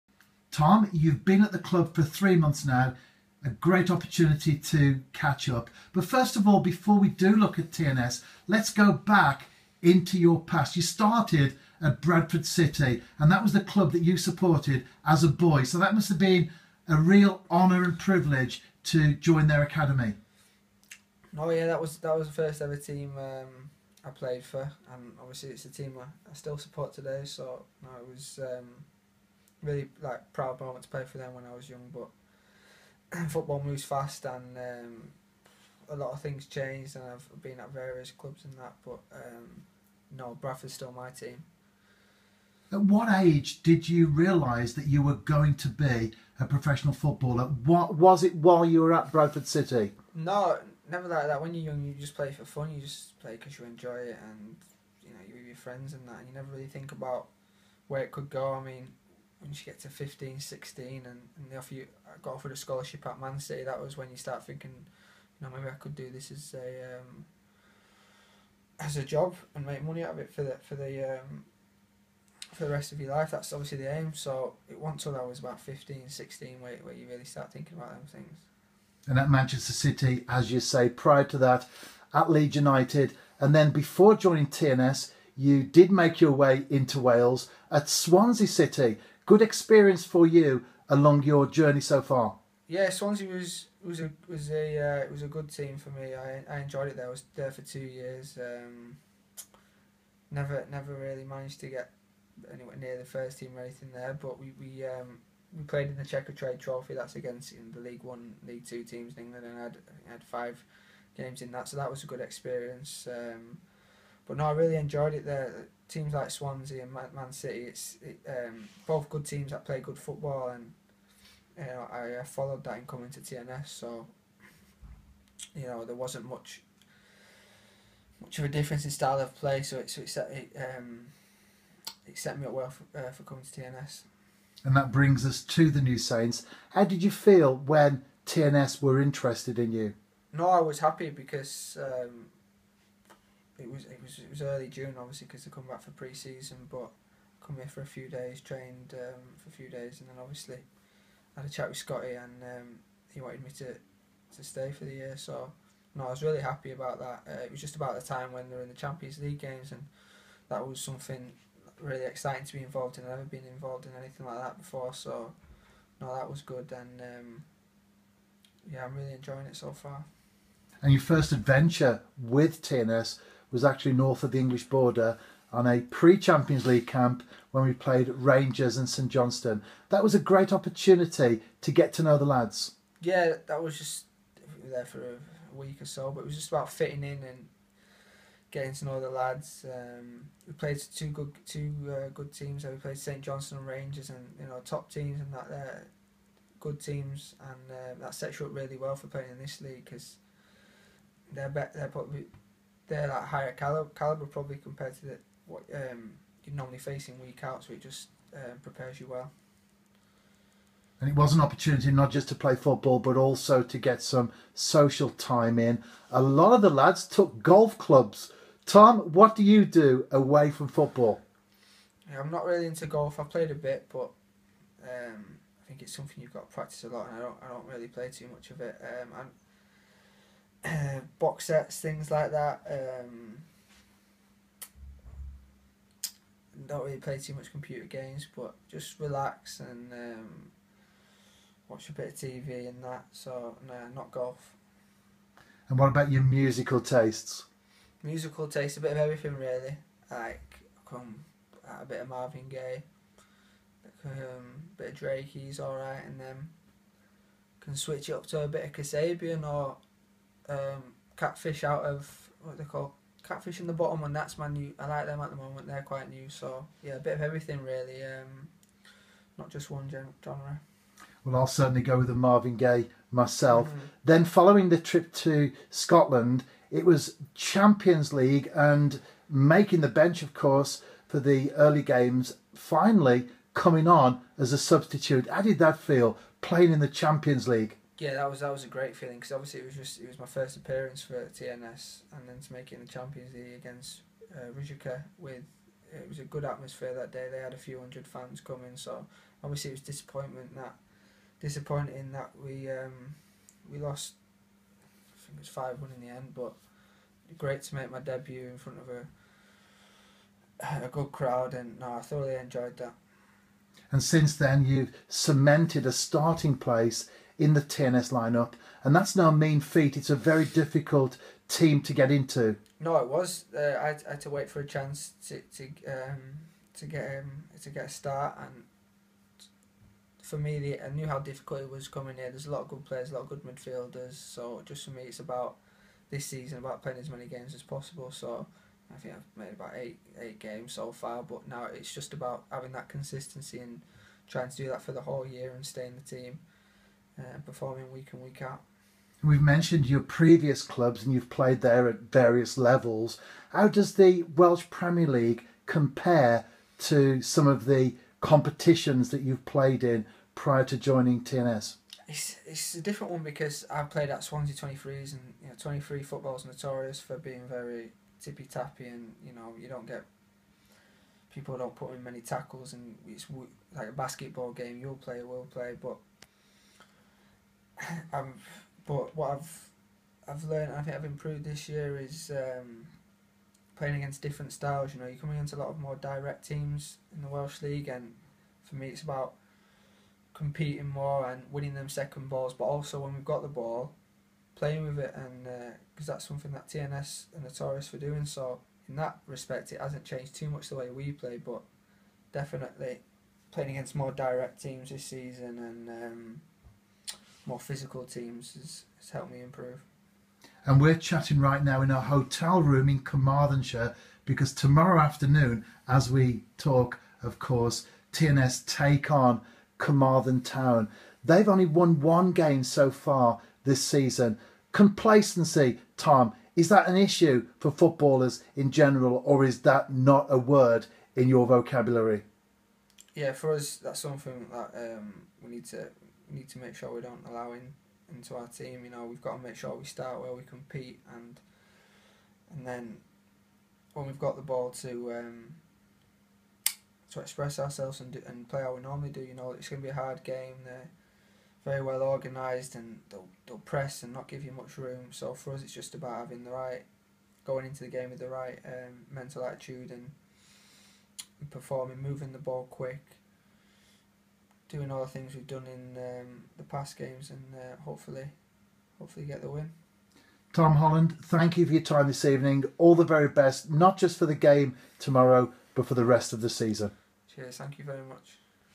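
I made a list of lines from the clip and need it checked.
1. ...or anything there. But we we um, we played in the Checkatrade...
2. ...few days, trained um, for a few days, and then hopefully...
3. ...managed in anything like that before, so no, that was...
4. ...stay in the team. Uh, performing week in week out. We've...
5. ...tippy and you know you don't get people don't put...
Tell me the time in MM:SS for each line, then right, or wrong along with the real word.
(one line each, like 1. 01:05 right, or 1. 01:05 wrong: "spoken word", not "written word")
1. 01:43 right
2. 02:27 wrong: "obviously", not "hopefully"
3. 02:43 wrong: "involved", not "managed"
4. 05:45 right
5. 06:08 wrong: "tappy", not "tippy".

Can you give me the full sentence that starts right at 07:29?
You know, it's going to be a hard game.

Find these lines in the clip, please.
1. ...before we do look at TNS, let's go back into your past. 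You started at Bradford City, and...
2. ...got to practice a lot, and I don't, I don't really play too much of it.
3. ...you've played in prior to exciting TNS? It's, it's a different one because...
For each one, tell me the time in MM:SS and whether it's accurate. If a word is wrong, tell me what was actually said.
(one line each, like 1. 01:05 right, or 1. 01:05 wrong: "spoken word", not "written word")
1. 00:06 right
2. 03:46 right
3. 05:59 wrong: "joining", not "exciting".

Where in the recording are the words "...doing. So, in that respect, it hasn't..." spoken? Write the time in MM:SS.
06:37.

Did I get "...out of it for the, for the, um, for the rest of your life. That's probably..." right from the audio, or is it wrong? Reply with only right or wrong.
wrong.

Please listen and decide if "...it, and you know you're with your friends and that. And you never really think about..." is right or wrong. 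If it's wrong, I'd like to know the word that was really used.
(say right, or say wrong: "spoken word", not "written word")
right.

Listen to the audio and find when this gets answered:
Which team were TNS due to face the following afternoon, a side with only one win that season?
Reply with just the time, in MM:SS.
06:59.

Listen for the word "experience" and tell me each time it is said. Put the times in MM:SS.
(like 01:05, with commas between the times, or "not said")
01:29, 01:52.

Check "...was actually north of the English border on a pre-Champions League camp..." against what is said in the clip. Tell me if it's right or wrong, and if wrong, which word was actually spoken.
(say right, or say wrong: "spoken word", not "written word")
right.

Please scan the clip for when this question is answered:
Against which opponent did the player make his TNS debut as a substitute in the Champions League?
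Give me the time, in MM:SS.
04:54.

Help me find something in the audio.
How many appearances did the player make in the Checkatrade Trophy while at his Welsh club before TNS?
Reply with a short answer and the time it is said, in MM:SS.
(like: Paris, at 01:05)
5, at 01:50.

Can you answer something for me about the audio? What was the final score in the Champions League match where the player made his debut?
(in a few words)
5-1.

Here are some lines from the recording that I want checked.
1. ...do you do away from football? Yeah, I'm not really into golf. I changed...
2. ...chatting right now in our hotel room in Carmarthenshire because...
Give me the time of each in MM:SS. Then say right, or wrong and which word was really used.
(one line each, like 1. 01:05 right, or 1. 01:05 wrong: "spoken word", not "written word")
1. 03:39 wrong: "played", not "changed"
2. 06:50 right.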